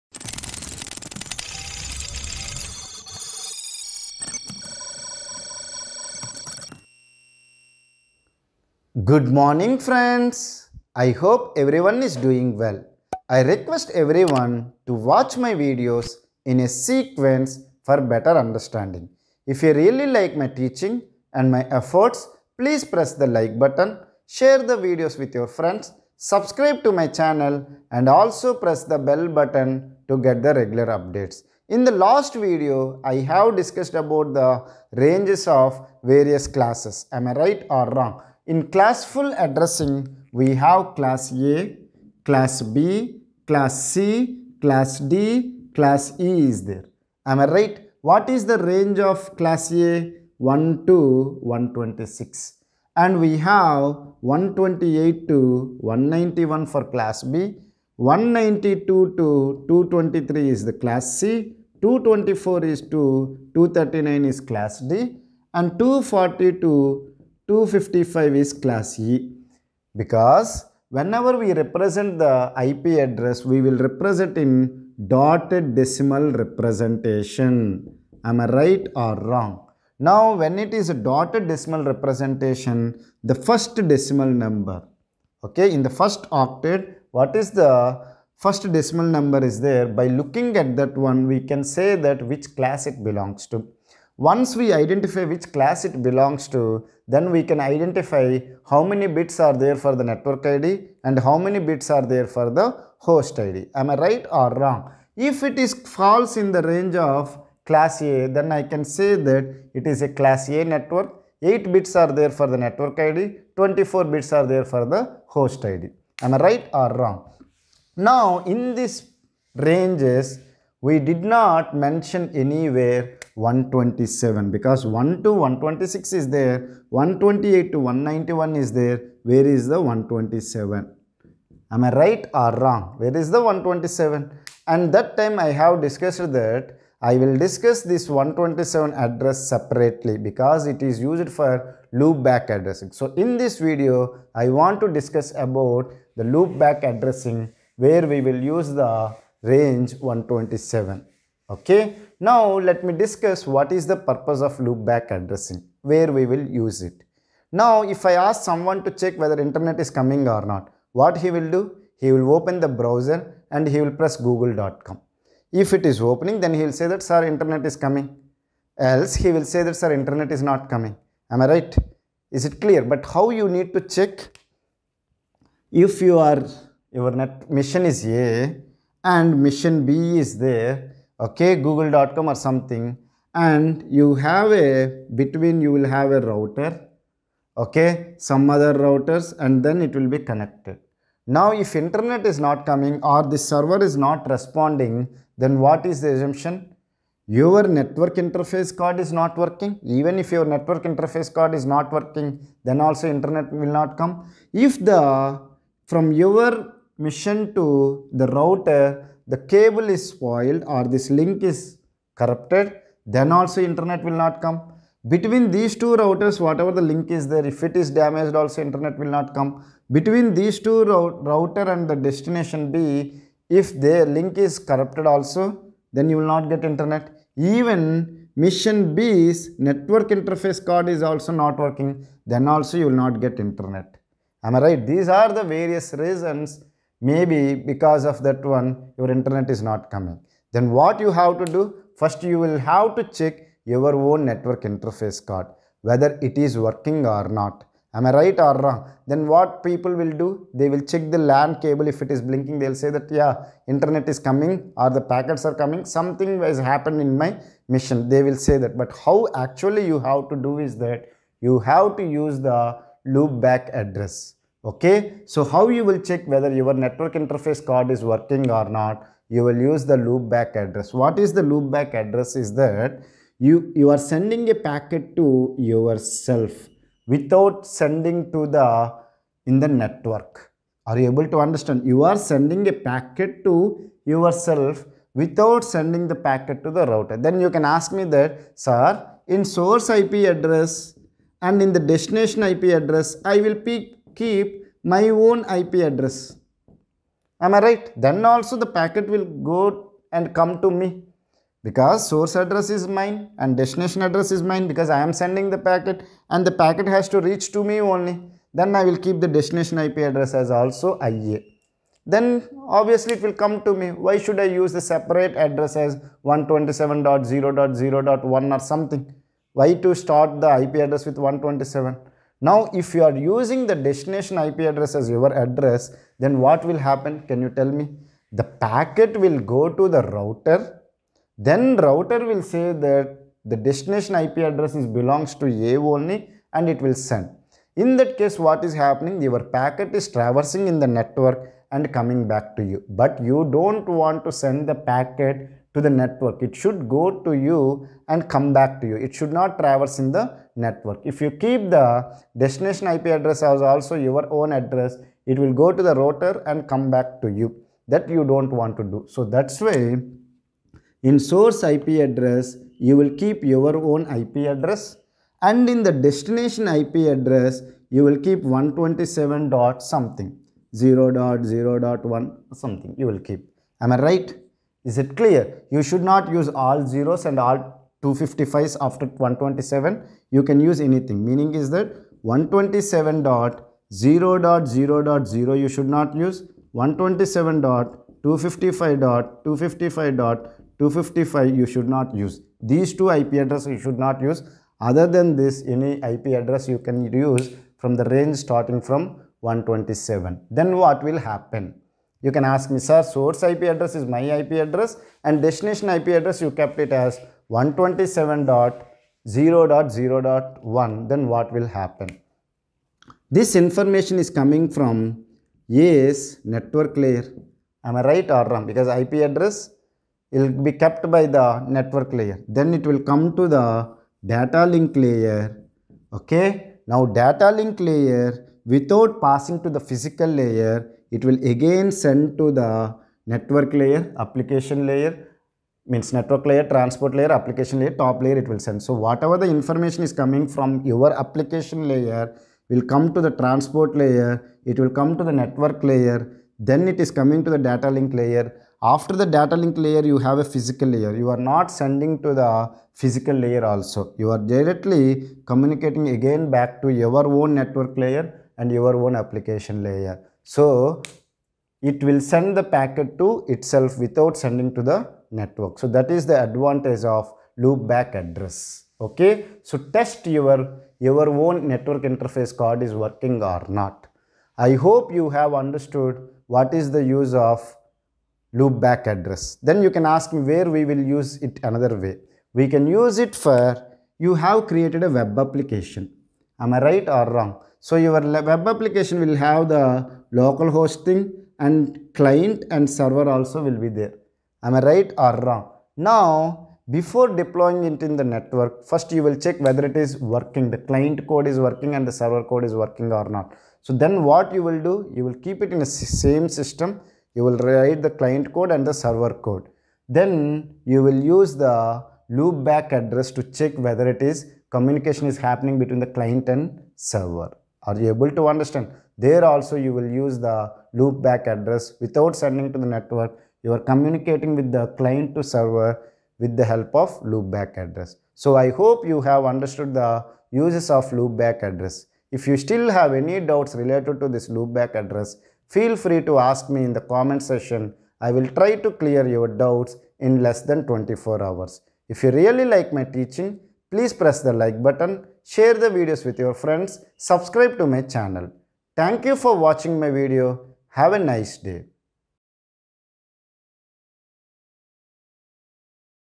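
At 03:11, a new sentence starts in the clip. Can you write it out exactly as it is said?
Now, if internet is not coming or the server is not responding, then what is the assumption?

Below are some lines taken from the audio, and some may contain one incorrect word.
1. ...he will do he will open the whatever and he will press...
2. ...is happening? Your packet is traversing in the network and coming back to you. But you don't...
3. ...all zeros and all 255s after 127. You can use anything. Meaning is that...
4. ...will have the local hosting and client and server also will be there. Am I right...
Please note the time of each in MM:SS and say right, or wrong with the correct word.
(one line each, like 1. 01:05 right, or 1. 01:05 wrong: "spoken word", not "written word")
1. 02:41 wrong: "browser", not "whatever"
2. 05:38 right
3. 06:16 right
4. 08:09 right.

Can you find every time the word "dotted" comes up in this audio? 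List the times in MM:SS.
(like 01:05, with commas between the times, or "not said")
01:15, 01:21.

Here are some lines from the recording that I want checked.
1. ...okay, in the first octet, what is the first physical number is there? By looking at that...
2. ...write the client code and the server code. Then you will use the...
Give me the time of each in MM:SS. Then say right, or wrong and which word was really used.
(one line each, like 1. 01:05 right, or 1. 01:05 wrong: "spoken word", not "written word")
1. 01:25 wrong: "decimal", not "physical"
2. 08:27 right.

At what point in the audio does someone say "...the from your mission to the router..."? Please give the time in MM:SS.
03:24.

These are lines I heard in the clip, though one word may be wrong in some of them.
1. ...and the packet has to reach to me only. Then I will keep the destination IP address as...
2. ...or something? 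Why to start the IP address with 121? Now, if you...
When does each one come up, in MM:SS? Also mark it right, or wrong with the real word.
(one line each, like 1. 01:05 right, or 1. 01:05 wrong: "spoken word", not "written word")
1. 05:06 right
2. 05:18 wrong: "127", not "121".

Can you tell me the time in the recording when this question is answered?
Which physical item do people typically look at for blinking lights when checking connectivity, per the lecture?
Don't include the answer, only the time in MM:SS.
04:11.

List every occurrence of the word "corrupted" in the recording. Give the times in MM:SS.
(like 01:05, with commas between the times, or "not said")
03:32, 03:44.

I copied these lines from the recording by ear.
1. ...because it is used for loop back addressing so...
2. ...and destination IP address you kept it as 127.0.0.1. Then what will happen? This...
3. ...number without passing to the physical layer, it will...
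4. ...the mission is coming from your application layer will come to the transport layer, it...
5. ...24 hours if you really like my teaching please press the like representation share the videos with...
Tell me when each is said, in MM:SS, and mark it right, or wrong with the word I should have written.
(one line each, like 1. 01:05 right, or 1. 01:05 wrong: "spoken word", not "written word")
1. 02:20 right
2. 06:45 right
3. 07:07 wrong: "layer", not "number"
4. 07:19 wrong: "information", not "mission"
5. 09:00 wrong: "button", not "representation".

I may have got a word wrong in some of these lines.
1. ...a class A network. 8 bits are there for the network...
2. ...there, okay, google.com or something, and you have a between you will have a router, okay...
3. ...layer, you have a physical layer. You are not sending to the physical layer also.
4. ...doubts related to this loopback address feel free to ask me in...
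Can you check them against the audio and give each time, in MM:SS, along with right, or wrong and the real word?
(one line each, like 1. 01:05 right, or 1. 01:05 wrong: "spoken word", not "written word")
1. 01:50 right
2. 03:00 right
3. 07:29 right
4. 08:53 right.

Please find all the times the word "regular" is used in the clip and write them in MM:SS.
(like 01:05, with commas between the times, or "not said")
00:30.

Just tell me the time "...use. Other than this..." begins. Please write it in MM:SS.
06:34.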